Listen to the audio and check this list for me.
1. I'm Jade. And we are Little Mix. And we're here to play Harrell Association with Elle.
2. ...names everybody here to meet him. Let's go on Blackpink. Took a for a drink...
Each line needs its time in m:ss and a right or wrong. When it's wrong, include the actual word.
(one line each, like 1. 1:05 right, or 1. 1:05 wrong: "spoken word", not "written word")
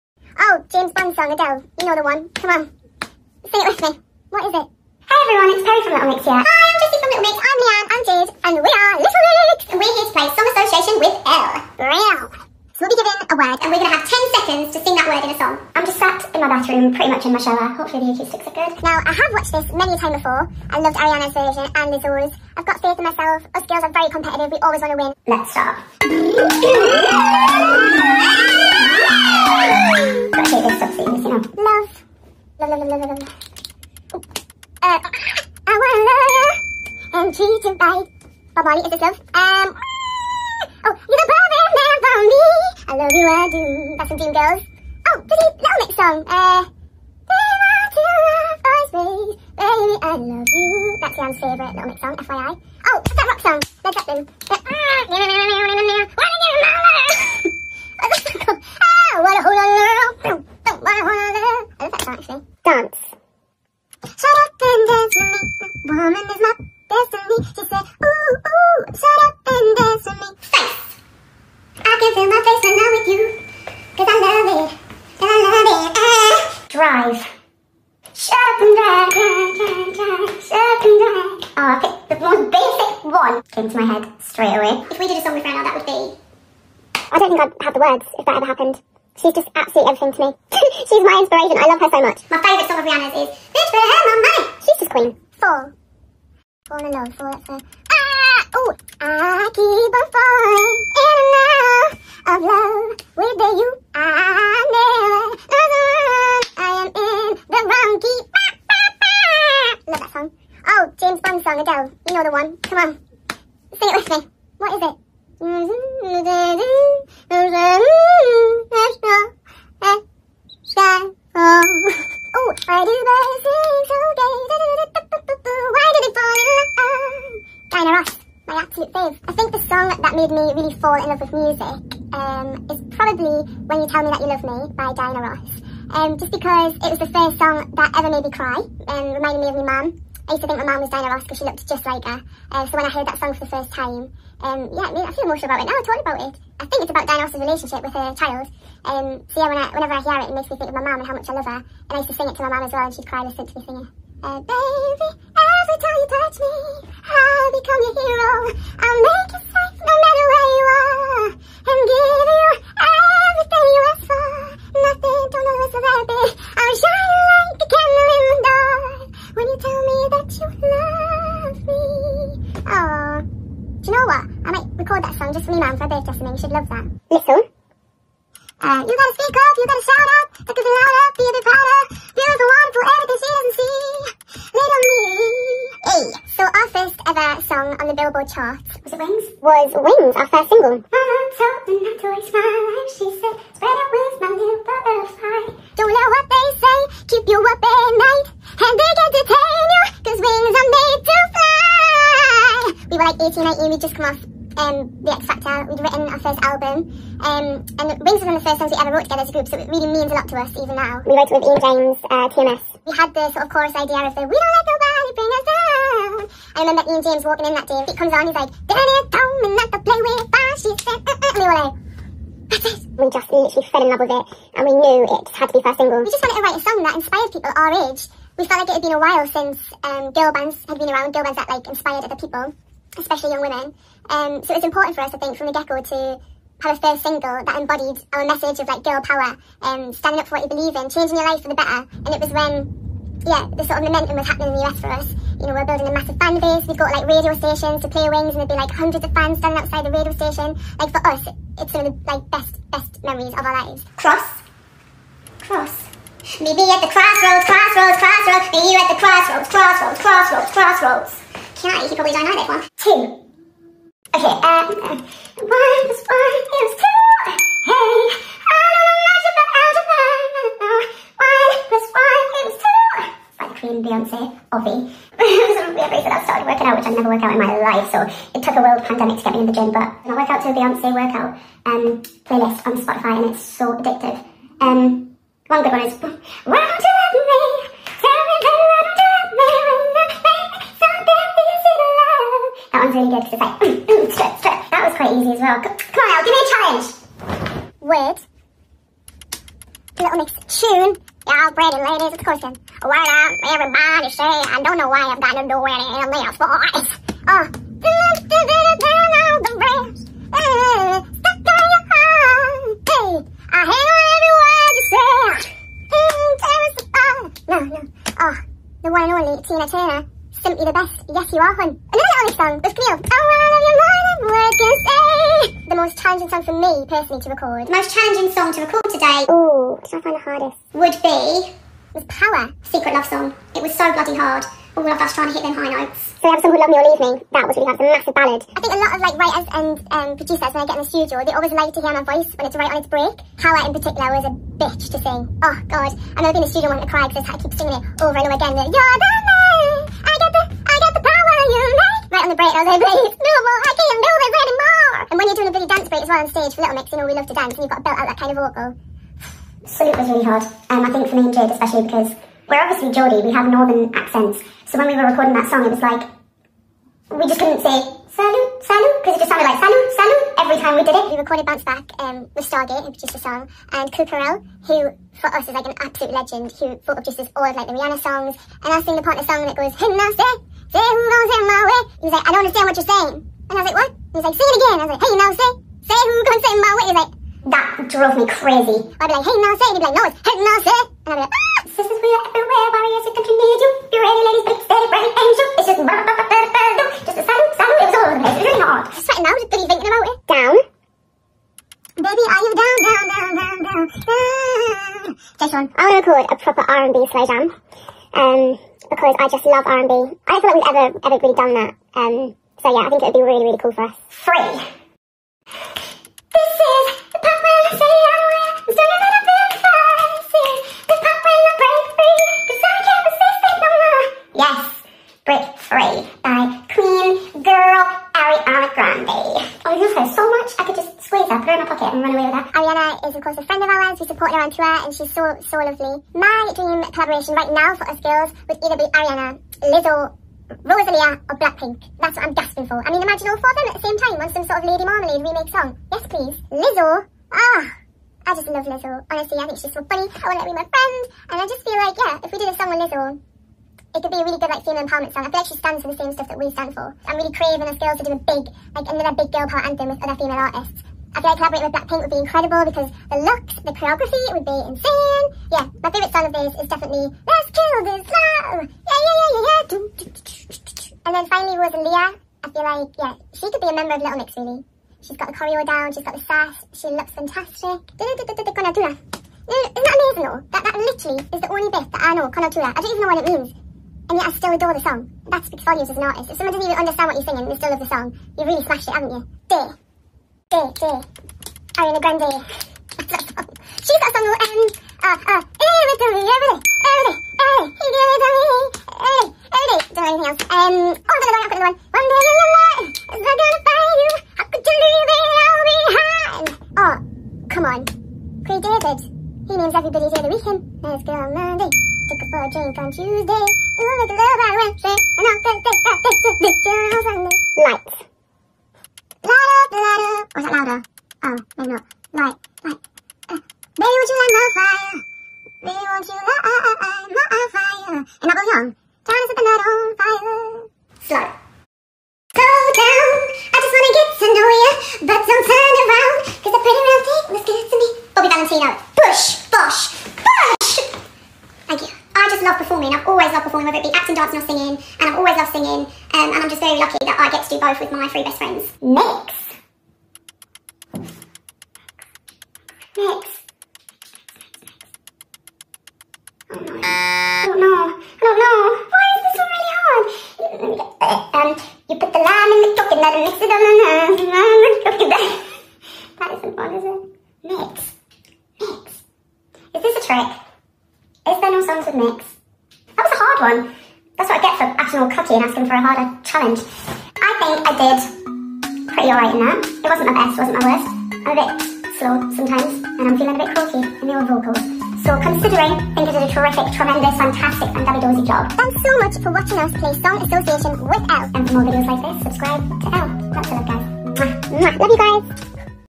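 1. 0:07 wrong: "Song", not "Harrell"
2. 8:29 wrong: "Monday", not "Blackpink".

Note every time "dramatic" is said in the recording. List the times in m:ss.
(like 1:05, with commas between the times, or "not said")
not said.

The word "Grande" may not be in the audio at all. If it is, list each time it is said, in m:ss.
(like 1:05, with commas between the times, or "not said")
7:08, 8:12.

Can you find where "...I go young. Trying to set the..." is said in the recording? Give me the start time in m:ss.
8:48.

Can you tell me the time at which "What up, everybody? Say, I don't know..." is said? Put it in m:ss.
5:02.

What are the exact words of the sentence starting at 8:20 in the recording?
Um oh another one, another one.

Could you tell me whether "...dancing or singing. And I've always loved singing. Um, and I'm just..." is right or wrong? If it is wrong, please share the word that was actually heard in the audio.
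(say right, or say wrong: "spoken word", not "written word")
right.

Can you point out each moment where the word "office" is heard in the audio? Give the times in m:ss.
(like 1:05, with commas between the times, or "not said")
not said.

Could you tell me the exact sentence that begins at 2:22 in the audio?
Uh, so when I heard that song for the first time, um, yeah, it made, I feel emotional about it.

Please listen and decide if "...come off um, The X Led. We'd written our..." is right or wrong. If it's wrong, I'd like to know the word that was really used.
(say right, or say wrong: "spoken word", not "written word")
wrong: "Factor", not "Led".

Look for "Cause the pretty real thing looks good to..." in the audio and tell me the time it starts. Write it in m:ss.
8:56.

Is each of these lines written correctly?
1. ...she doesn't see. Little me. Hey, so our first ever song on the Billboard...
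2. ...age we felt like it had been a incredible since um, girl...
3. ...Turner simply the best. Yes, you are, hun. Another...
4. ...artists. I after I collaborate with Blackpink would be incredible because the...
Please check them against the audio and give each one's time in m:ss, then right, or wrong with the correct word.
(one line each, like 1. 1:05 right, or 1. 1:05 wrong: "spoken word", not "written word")
1. 3:03 right
2. 3:47 wrong: "while", not "incredible"
3. 5:19 right
4. 7:40 right.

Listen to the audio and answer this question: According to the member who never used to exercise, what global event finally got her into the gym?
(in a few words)
A world pandemic.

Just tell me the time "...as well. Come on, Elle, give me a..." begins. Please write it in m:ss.
4:55.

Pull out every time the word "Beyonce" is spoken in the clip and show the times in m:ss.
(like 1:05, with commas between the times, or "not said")
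4:33, 4:40.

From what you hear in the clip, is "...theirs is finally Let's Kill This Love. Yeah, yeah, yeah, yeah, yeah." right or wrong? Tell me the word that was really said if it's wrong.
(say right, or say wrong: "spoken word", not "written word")
wrong: "definitely", not "finally".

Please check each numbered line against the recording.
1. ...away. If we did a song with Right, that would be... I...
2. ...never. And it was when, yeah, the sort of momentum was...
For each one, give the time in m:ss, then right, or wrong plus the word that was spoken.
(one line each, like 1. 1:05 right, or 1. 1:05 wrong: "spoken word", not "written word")
1. 1:24 wrong: "Rihanna", not "Right"
2. 4:01 wrong: "better", not "never".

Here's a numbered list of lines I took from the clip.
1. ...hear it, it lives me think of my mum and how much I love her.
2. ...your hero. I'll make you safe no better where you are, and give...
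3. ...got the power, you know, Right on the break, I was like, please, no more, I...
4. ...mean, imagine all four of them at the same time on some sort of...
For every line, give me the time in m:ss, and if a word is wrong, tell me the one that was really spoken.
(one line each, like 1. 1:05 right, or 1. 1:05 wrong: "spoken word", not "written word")
1. 2:30 wrong: "makes", not "lives"
2. 2:37 wrong: "matter", not "better"
3. 5:50 right
4. 7:22 right.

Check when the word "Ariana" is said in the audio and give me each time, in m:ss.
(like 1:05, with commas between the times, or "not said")
0:20, 7:08, 7:18, 8:11.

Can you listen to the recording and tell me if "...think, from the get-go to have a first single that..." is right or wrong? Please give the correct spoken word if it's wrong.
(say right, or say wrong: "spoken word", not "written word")
right.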